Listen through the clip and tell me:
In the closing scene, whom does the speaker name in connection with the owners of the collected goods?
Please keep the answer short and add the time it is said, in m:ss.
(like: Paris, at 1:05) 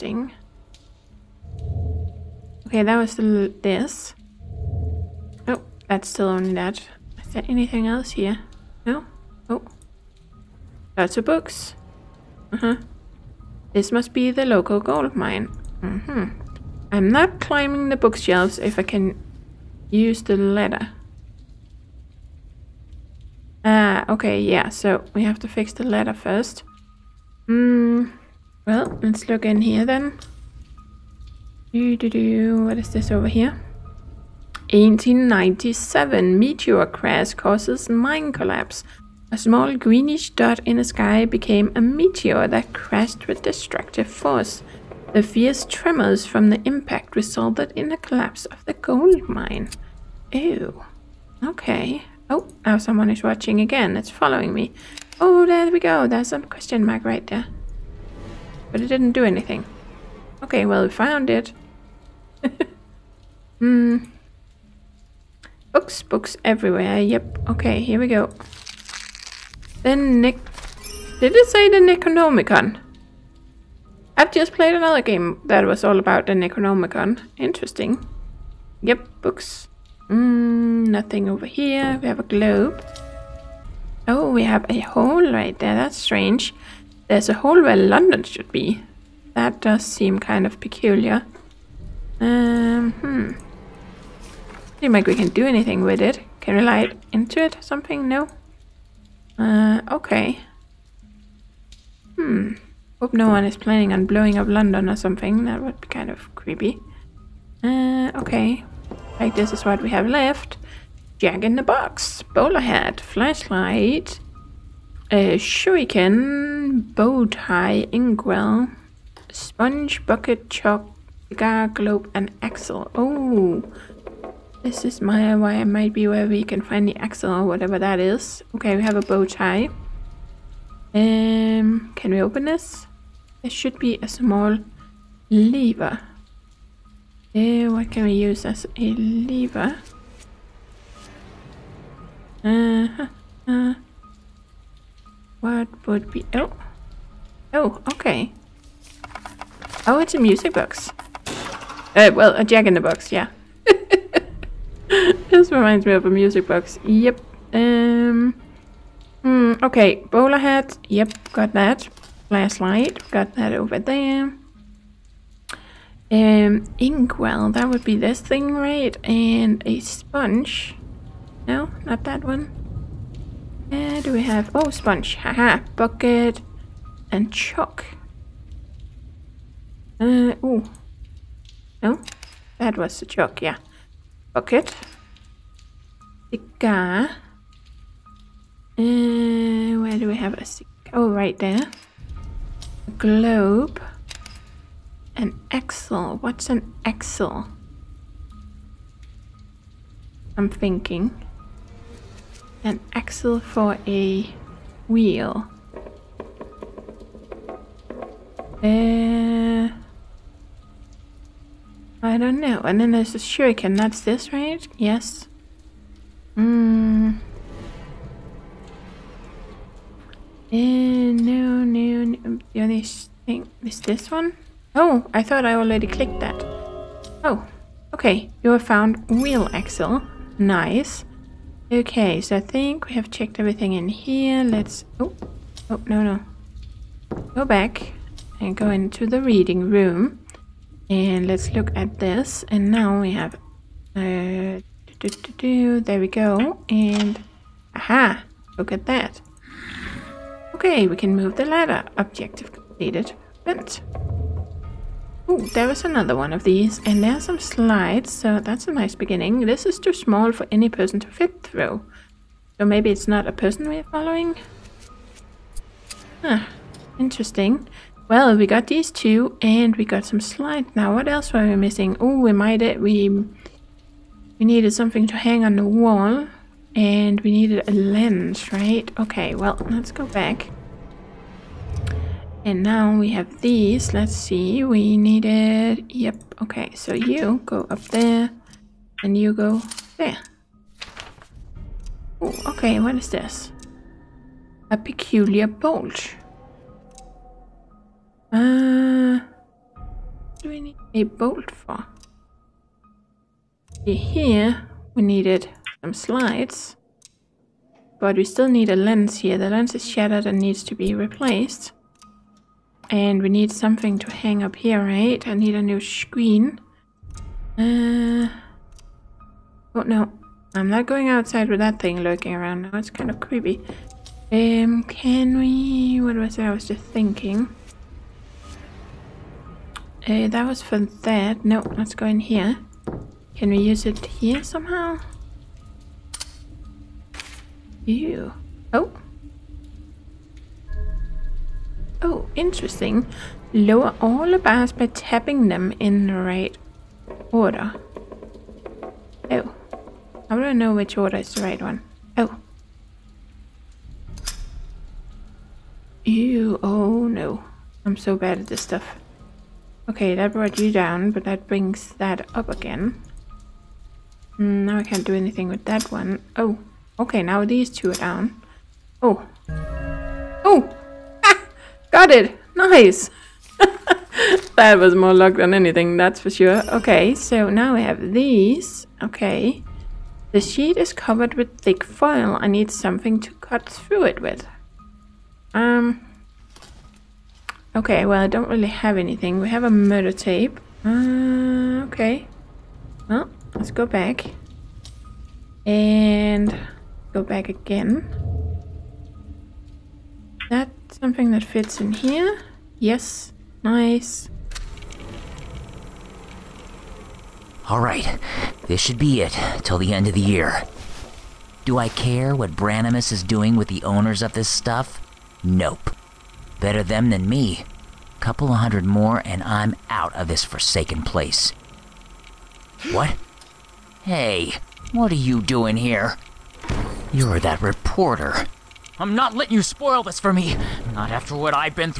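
Branimus, at 6:52.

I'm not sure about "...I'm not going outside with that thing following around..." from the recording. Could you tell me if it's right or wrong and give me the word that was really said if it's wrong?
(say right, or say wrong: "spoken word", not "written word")
wrong: "lurking", not "following".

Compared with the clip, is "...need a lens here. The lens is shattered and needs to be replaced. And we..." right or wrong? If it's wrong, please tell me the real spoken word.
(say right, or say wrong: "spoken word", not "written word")
right.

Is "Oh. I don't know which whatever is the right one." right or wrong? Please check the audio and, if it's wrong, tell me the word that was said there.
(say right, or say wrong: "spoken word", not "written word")
wrong: "order", not "whatever".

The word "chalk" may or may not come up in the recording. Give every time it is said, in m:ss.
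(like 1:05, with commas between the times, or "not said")
2:00, 2:57, 3:03.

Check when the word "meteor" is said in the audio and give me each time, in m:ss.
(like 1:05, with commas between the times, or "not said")
0:36, 0:41.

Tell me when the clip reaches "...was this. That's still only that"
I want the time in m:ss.
0:02.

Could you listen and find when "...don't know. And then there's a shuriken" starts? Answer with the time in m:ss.
3:32.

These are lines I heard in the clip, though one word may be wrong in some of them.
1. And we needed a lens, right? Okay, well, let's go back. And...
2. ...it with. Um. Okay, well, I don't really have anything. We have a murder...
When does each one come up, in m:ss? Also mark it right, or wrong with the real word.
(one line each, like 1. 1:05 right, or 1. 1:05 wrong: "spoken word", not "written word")
1. 4:36 right
2. 6:24 right.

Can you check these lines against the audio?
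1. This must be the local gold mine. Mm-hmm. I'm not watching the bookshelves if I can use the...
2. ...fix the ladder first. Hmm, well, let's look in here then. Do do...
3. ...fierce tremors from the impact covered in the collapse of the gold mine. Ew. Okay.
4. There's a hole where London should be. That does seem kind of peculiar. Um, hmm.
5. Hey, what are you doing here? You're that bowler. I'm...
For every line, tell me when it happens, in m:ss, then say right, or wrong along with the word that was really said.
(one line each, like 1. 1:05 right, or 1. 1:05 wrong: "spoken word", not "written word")
1. 0:13 wrong: "climbing", not "watching"
2. 0:25 right
3. 0:45 wrong: "resulted", not "covered"
4. 1:27 right
5. 7:04 wrong: "reporter", not "bowler".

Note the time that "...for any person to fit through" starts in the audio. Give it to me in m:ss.
4:20.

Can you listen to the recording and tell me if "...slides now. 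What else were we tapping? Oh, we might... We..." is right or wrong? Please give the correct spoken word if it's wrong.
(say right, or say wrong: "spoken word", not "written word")
wrong: "missing", not "tapping".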